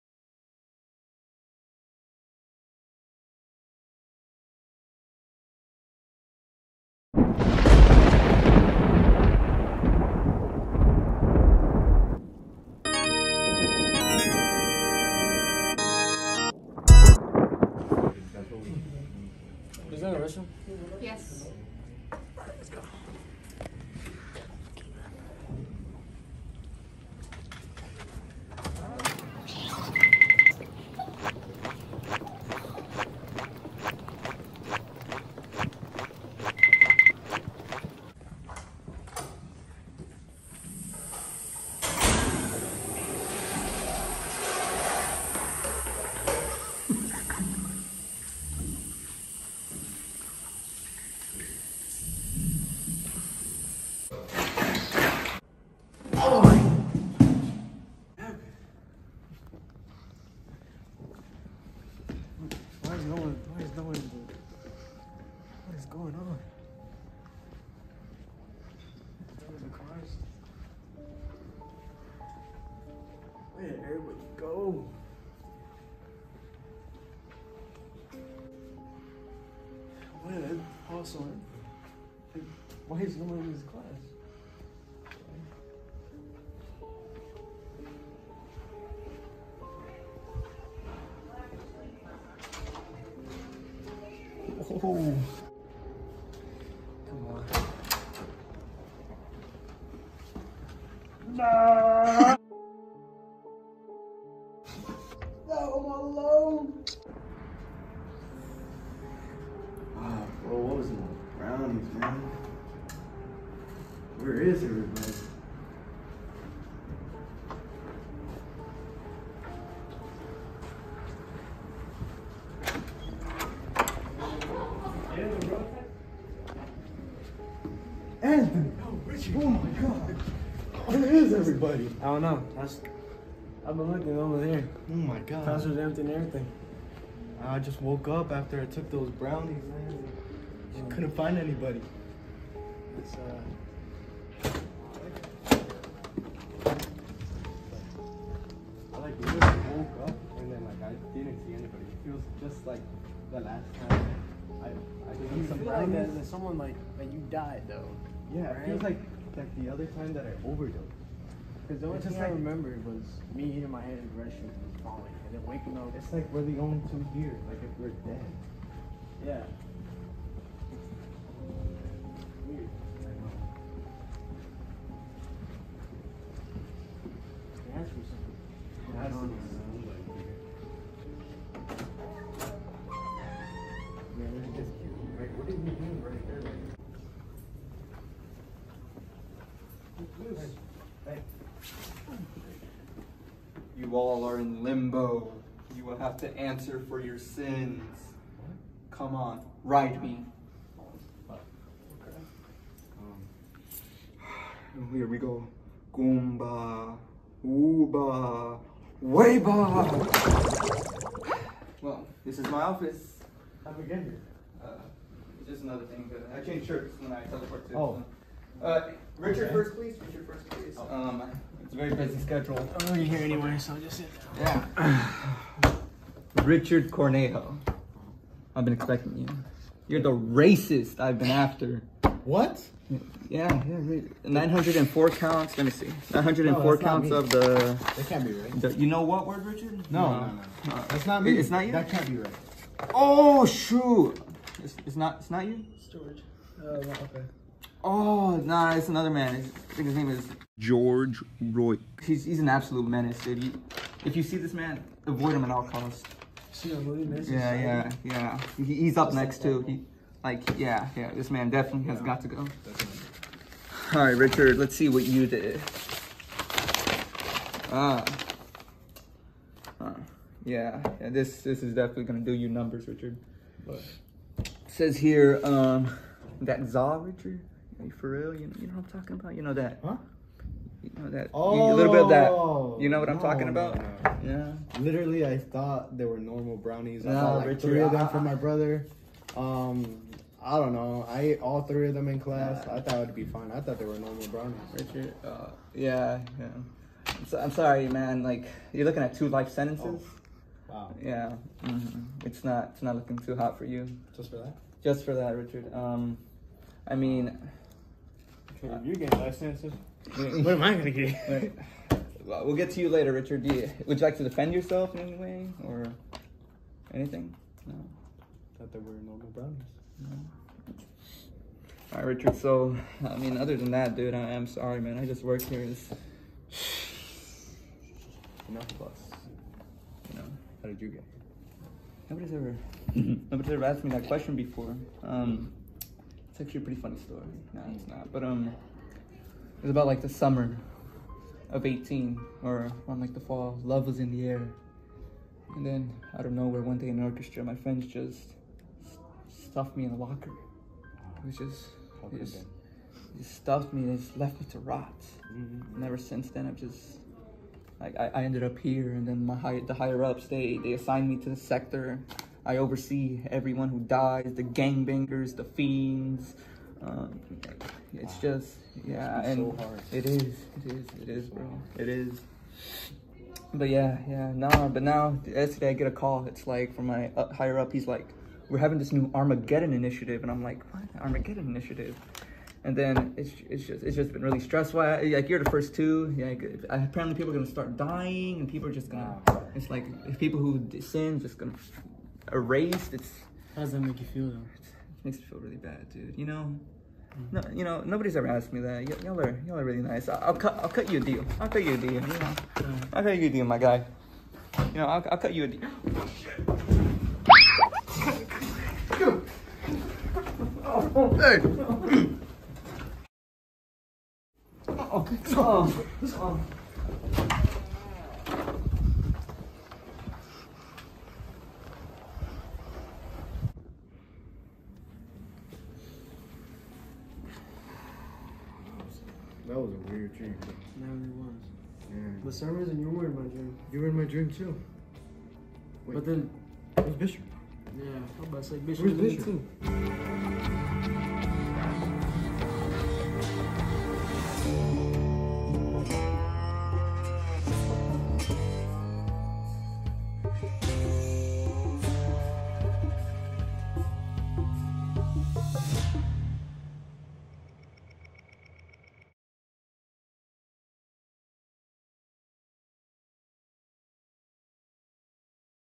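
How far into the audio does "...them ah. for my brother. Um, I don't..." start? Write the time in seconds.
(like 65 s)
287 s.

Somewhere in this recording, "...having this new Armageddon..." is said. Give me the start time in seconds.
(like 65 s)
378 s.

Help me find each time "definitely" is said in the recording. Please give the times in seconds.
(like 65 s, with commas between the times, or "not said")
261 s, 271 s.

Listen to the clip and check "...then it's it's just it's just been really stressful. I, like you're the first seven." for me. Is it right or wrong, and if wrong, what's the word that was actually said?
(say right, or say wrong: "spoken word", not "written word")
wrong: "two", not "seven".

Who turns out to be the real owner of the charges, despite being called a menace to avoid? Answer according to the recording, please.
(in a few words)
George Roy.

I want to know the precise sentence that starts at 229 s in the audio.
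You're the racist I've been after.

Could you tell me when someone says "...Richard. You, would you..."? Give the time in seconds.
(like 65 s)
313 s.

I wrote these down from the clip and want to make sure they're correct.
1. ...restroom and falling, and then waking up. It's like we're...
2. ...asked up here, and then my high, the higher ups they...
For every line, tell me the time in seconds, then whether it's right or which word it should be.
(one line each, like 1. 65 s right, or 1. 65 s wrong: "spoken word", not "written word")
1. 164 s right
2. 358 s wrong: "ended", not "asked".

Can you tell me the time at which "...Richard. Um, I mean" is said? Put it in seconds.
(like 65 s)
305 s.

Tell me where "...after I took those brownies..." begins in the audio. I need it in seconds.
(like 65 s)
138 s.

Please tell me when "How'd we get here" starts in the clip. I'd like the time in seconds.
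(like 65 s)
213 s.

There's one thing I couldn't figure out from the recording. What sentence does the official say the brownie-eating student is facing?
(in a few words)
Two life sentences.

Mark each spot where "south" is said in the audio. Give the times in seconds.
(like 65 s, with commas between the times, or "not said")
not said.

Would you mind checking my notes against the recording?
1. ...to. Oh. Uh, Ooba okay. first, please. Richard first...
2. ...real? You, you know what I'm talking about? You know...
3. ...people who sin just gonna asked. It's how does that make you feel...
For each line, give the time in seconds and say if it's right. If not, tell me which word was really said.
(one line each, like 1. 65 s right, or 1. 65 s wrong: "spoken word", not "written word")
1. 217 s wrong: "Richard", not "Ooba"
2. 278 s right
3. 390 s wrong: "erased", not "asked".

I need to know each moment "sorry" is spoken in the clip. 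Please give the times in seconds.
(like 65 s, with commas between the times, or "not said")
297 s, 324 s.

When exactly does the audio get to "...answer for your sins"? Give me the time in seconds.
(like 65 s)
196 s.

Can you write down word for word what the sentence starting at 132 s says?
That's, I've been looking over there.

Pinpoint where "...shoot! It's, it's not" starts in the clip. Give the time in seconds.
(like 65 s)
243 s.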